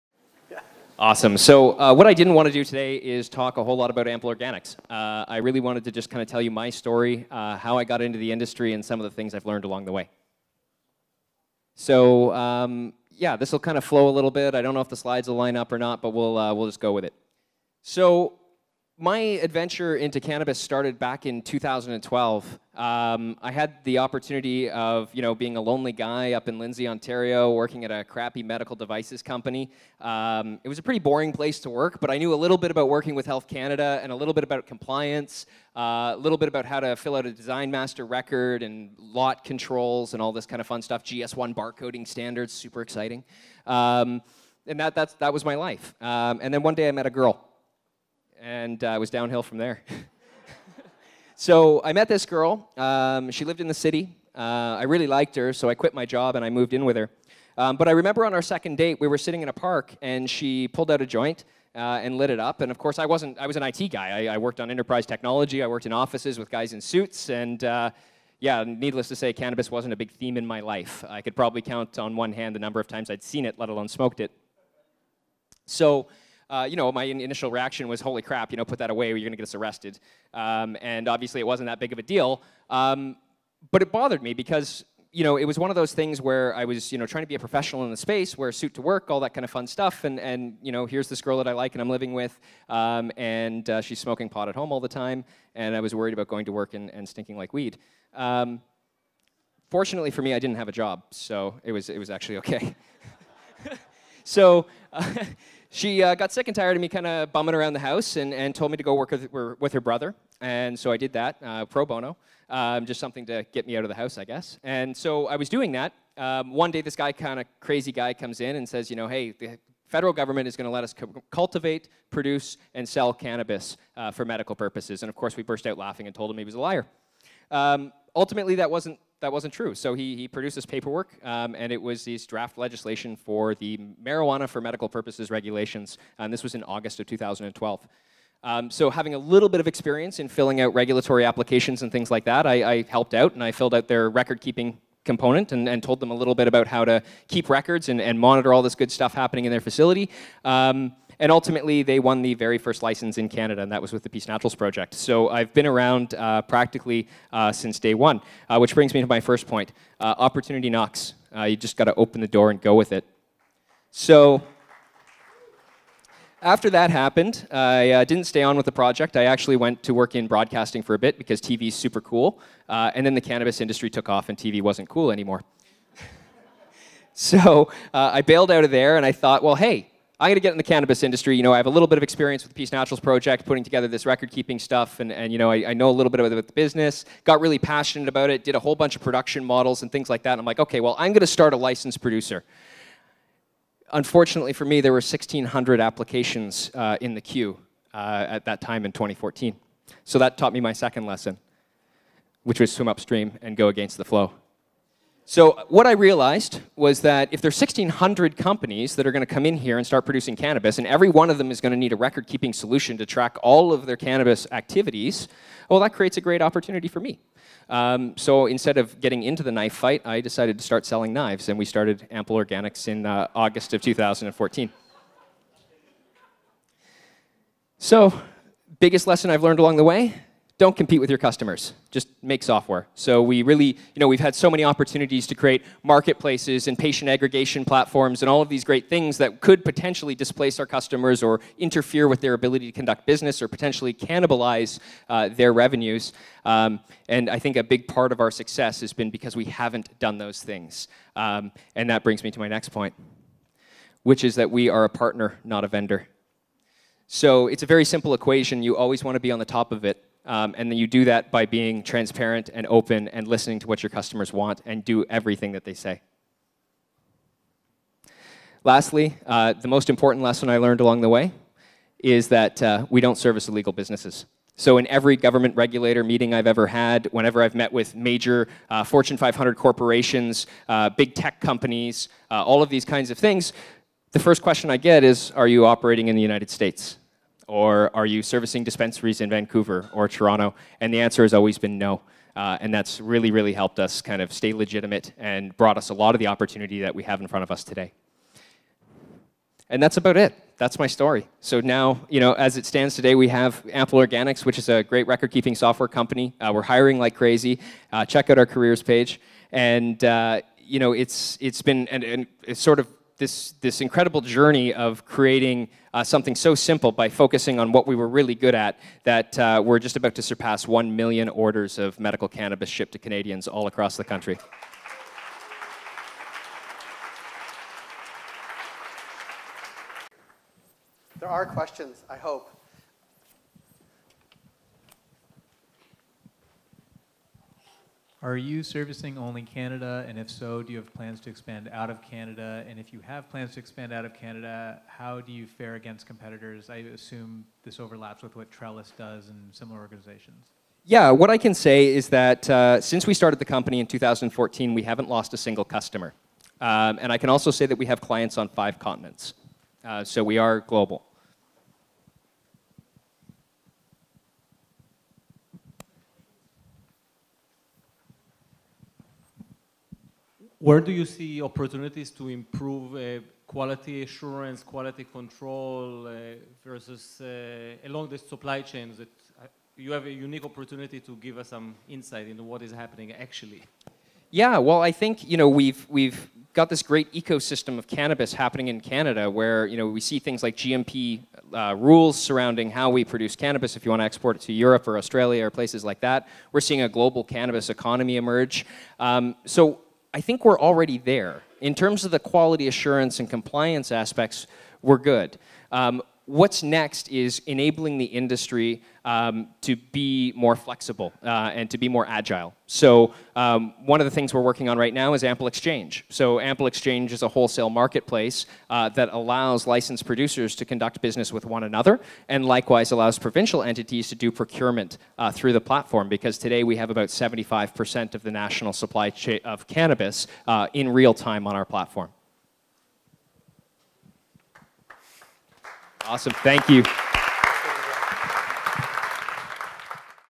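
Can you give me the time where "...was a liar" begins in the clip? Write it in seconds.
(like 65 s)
126 s.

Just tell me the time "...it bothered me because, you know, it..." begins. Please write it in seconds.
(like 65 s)
83 s.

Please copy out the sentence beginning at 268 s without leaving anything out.
Lastly, uh, the most important lesson I learned along the way is that uh, we don't service illegal businesses.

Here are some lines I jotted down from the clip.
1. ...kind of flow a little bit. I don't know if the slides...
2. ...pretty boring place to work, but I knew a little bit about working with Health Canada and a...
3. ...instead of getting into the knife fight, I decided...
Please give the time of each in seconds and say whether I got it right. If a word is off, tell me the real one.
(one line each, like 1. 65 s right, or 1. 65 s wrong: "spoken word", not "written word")
1. 13 s right
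2. 30 s right
3. 218 s right.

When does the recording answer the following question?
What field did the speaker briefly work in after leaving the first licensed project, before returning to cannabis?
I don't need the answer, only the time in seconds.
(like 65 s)
170 s.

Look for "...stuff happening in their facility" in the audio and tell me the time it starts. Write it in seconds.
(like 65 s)
148 s.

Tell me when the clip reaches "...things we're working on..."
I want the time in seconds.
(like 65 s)
414 s.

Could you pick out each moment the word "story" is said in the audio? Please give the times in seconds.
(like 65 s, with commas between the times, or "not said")
6 s, 300 s.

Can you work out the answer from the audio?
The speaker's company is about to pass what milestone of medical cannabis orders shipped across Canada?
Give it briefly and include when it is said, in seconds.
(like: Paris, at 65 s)
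1 million, at 320 s.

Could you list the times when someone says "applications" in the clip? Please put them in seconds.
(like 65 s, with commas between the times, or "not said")
141 s, 195 s.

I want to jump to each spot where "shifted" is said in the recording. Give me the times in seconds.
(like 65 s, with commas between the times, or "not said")
not said.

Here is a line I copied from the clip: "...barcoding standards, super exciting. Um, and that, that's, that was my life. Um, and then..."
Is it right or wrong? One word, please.
right.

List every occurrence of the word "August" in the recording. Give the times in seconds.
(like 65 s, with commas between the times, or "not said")
136 s, 223 s.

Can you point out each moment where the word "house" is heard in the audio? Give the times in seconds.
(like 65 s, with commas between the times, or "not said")
107 s, 113 s.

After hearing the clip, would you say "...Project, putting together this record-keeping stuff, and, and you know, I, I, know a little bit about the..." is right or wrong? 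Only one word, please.
right.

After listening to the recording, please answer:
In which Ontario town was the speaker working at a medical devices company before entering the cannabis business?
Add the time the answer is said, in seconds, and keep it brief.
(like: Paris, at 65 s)
Lindsay, at 26 s.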